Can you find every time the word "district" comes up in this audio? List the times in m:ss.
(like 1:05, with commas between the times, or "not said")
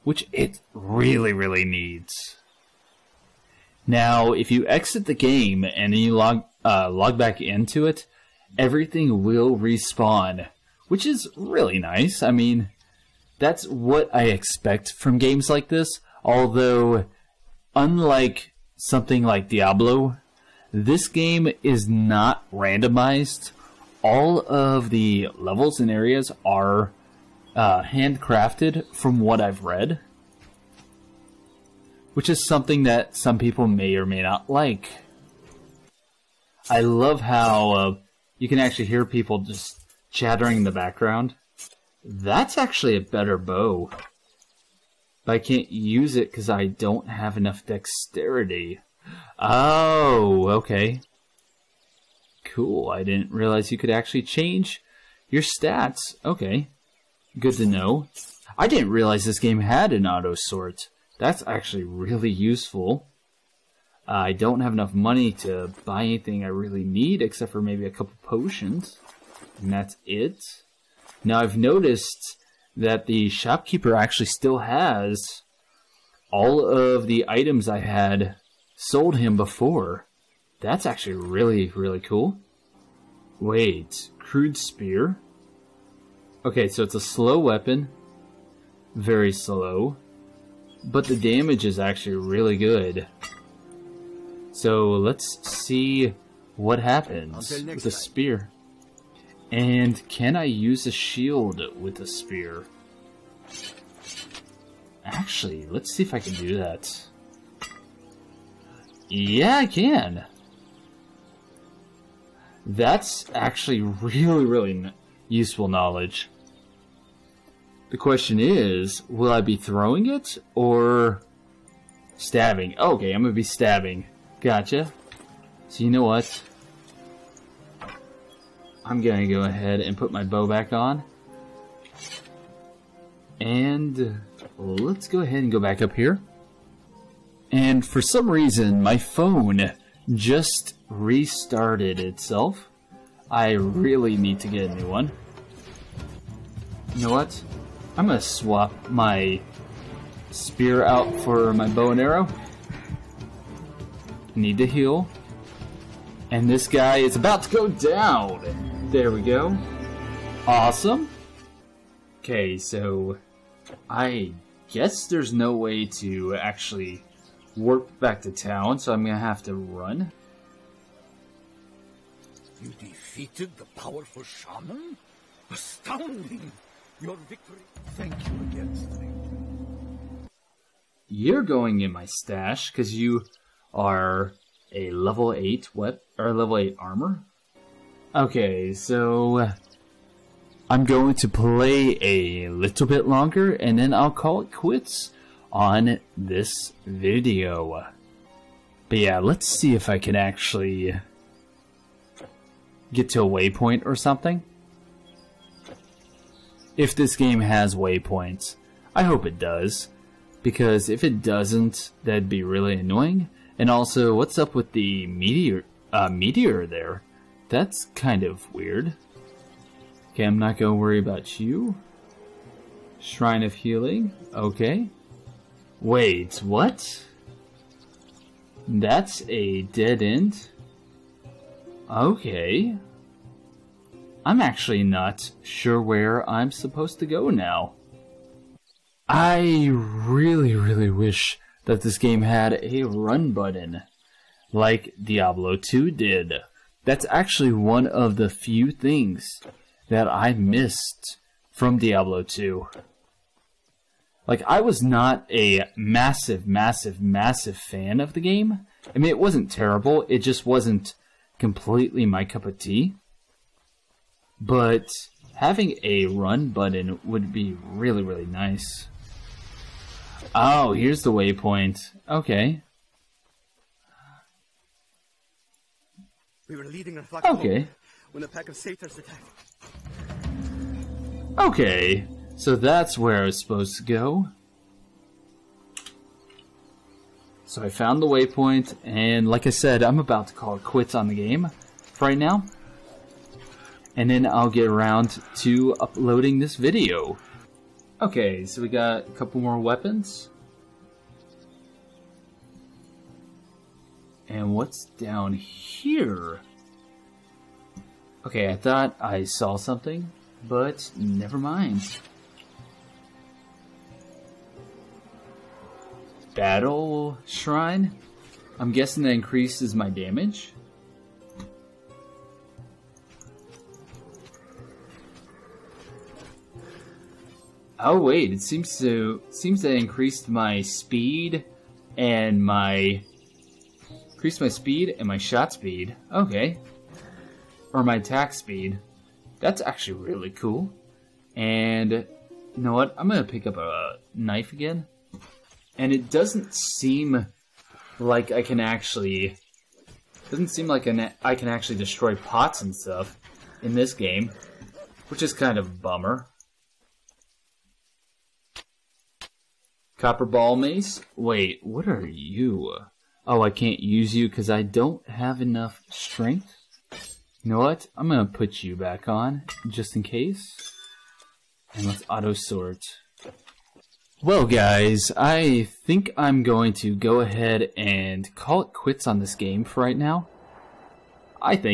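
not said.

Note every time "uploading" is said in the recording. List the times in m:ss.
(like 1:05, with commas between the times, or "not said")
4:55.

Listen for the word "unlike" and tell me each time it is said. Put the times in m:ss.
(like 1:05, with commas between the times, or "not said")
0:17.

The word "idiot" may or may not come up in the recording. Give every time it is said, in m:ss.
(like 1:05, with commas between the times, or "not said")
not said.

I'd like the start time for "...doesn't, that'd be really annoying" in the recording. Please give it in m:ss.
3:31.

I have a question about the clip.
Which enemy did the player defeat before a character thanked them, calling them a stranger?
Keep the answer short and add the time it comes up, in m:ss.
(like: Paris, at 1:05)
The powerful shaman, at 2:53.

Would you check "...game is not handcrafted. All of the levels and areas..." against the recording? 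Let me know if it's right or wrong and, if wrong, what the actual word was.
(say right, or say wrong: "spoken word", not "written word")
wrong: "randomized", not "handcrafted".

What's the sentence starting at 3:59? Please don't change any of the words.
I really, really wish that this game had a run button, like Diablo 2 did.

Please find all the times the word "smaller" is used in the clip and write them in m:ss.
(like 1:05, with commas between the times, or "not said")
not said.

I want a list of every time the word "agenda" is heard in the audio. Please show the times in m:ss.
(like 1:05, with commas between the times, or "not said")
not said.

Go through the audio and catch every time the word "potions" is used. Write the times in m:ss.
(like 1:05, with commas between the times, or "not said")
1:08.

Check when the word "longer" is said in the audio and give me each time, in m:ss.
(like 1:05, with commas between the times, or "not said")
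3:13.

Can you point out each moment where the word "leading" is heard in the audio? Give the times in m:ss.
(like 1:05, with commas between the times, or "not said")
4:36.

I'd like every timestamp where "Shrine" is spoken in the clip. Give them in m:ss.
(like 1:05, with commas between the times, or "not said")
3:42, 5:17.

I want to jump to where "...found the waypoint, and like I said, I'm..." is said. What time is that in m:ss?
4:47.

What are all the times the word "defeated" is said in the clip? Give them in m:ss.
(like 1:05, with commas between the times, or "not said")
2:52.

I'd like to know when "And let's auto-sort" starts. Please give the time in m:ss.
6:11.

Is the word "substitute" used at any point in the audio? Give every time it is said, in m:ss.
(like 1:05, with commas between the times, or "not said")
not said.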